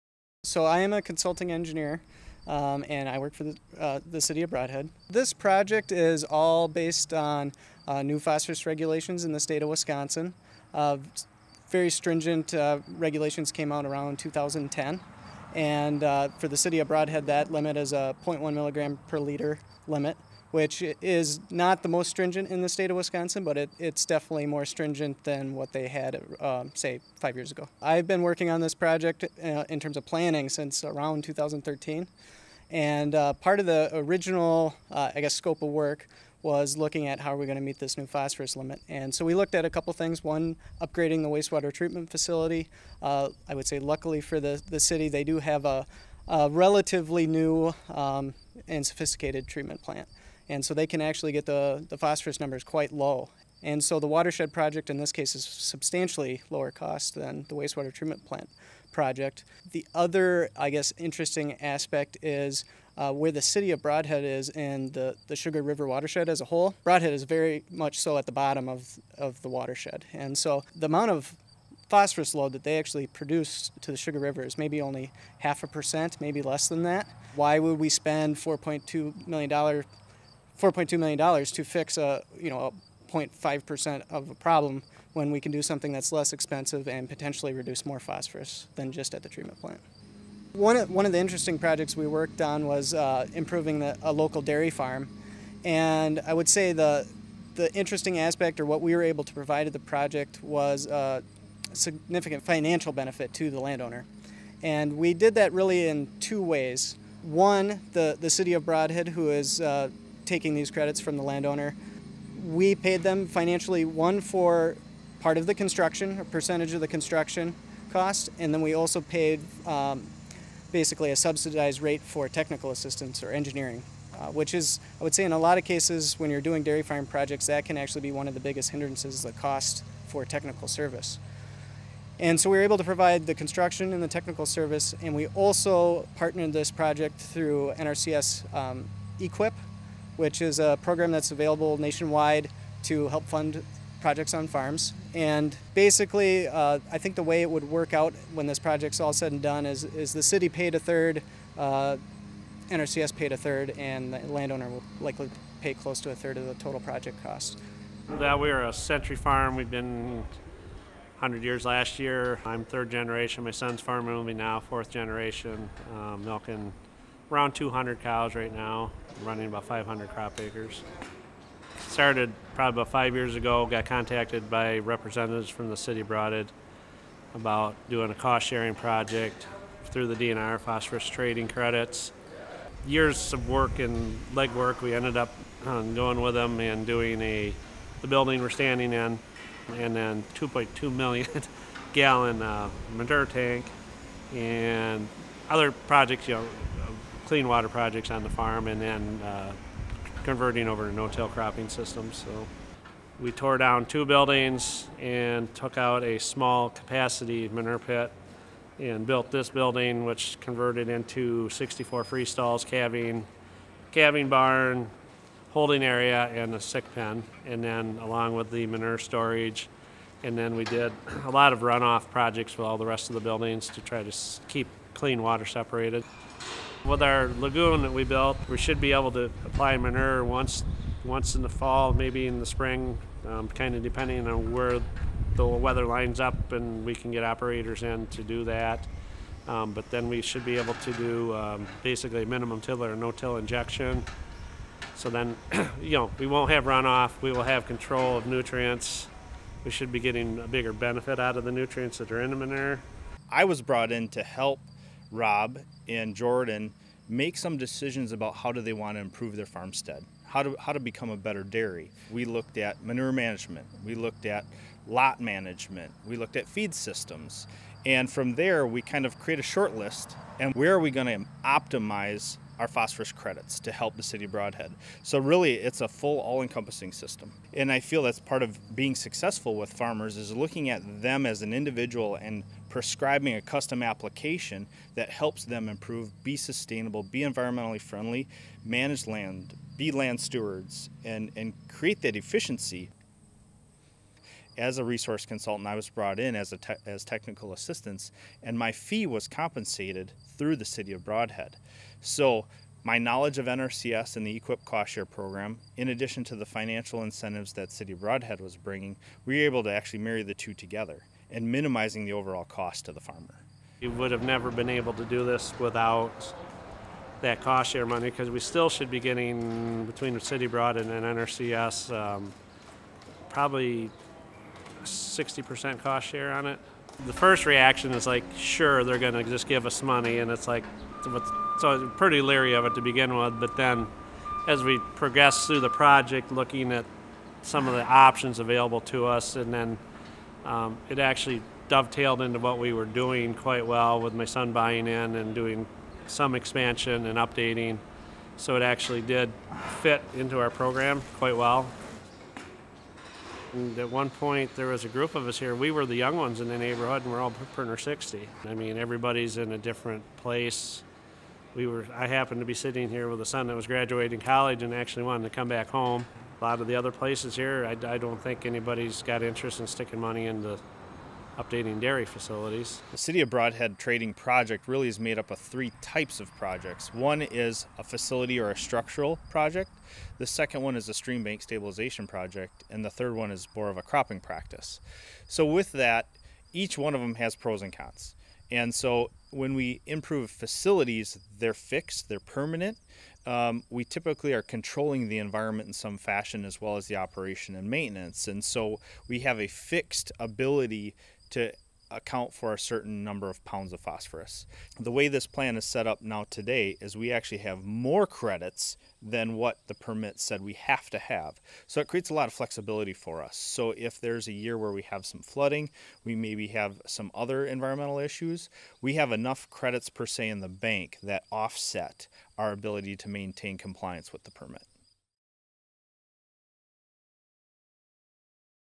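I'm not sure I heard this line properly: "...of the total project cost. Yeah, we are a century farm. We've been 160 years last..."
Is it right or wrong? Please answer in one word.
wrong.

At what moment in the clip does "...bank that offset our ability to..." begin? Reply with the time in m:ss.
7:00.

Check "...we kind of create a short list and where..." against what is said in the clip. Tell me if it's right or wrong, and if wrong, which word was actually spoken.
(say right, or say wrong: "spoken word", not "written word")
right.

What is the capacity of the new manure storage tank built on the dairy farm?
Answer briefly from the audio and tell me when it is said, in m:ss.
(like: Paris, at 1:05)
2.2 million gallons, at 3:10.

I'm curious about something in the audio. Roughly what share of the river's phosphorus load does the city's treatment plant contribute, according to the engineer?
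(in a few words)
half a percent.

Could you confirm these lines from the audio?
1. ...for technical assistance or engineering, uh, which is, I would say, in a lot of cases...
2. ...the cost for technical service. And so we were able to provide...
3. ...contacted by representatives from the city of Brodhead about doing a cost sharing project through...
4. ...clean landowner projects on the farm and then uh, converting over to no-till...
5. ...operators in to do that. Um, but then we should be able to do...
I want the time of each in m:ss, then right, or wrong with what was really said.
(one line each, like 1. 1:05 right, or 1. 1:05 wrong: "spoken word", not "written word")
1. 2:02 right
2. 2:09 right
3. 2:53 right
4. 3:17 wrong: "water", not "landowner"
5. 3:57 right.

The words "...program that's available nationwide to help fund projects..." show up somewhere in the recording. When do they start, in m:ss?
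2:20.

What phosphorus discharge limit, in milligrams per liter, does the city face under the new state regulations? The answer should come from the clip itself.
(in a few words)
0.1 milligram per liter.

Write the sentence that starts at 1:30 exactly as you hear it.
One of, one of the interesting projects we worked on was uh, improving the, a local dairy farm.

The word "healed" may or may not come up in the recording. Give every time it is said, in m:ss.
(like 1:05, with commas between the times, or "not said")
not said.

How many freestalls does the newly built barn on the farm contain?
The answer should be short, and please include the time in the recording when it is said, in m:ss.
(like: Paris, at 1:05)
64, at 3:31.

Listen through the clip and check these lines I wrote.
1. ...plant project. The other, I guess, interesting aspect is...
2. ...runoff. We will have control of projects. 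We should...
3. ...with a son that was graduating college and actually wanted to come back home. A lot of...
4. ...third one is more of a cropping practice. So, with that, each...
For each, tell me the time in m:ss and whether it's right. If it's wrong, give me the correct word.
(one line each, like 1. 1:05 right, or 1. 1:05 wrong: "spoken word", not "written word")
1. 0:58 right
2. 4:06 wrong: "nutrients", not "projects"
3. 6:03 right
4. 6:22 right.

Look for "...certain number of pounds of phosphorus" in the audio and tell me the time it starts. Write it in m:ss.
6:42.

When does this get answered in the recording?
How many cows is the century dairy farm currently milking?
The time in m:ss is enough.
2:47.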